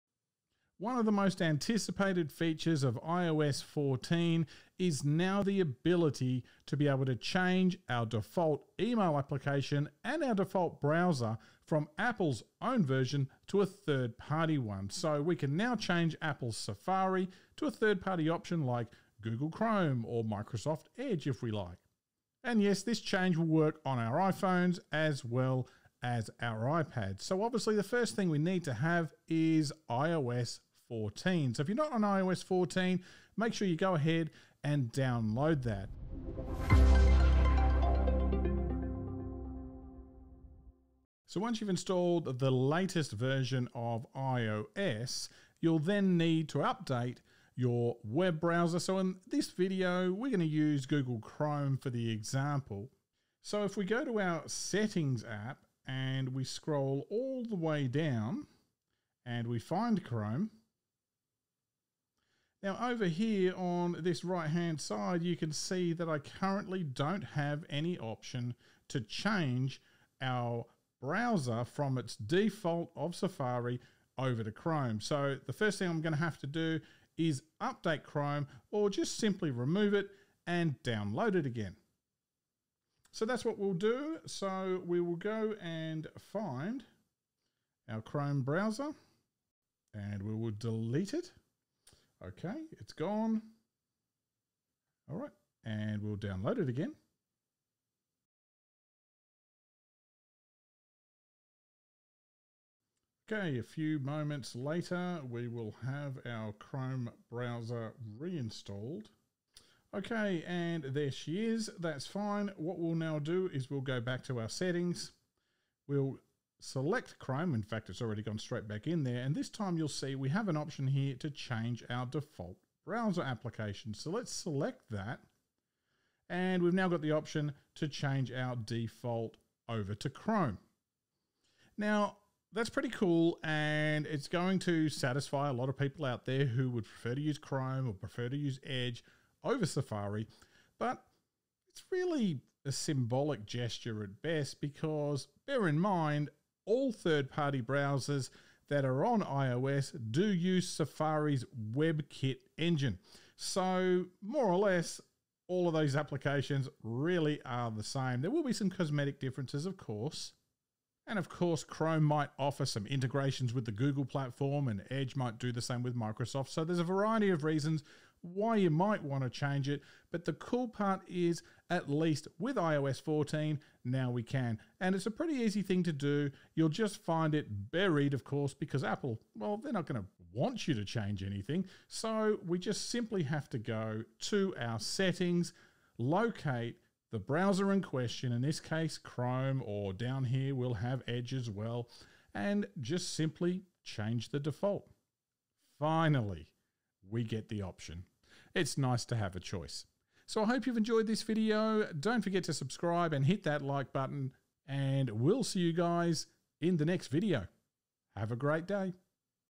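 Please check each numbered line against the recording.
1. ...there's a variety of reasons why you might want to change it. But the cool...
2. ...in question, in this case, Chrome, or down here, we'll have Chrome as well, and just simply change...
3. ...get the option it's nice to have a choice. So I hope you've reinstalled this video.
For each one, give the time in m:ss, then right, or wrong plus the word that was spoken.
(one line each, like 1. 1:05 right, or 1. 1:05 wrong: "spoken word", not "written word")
1. 2:46 right
2. 3:07 wrong: "Edge", not "Chrome"
3. 3:17 wrong: "enjoyed", not "reinstalled".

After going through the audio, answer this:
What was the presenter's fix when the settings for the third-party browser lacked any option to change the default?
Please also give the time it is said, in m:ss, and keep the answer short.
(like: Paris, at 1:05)
Remove it and download it again, at 1:19.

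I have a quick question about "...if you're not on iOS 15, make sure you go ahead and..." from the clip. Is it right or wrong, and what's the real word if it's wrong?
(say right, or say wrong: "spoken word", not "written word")
wrong: "14", not "15".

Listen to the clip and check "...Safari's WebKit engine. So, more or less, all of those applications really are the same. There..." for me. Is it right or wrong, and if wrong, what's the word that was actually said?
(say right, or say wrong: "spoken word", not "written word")
right.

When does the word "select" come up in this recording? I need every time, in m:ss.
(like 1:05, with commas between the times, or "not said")
1:56, 2:04.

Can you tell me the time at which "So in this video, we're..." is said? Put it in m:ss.
0:48.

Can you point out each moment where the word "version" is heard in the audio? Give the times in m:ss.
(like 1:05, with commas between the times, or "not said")
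0:12, 0:43.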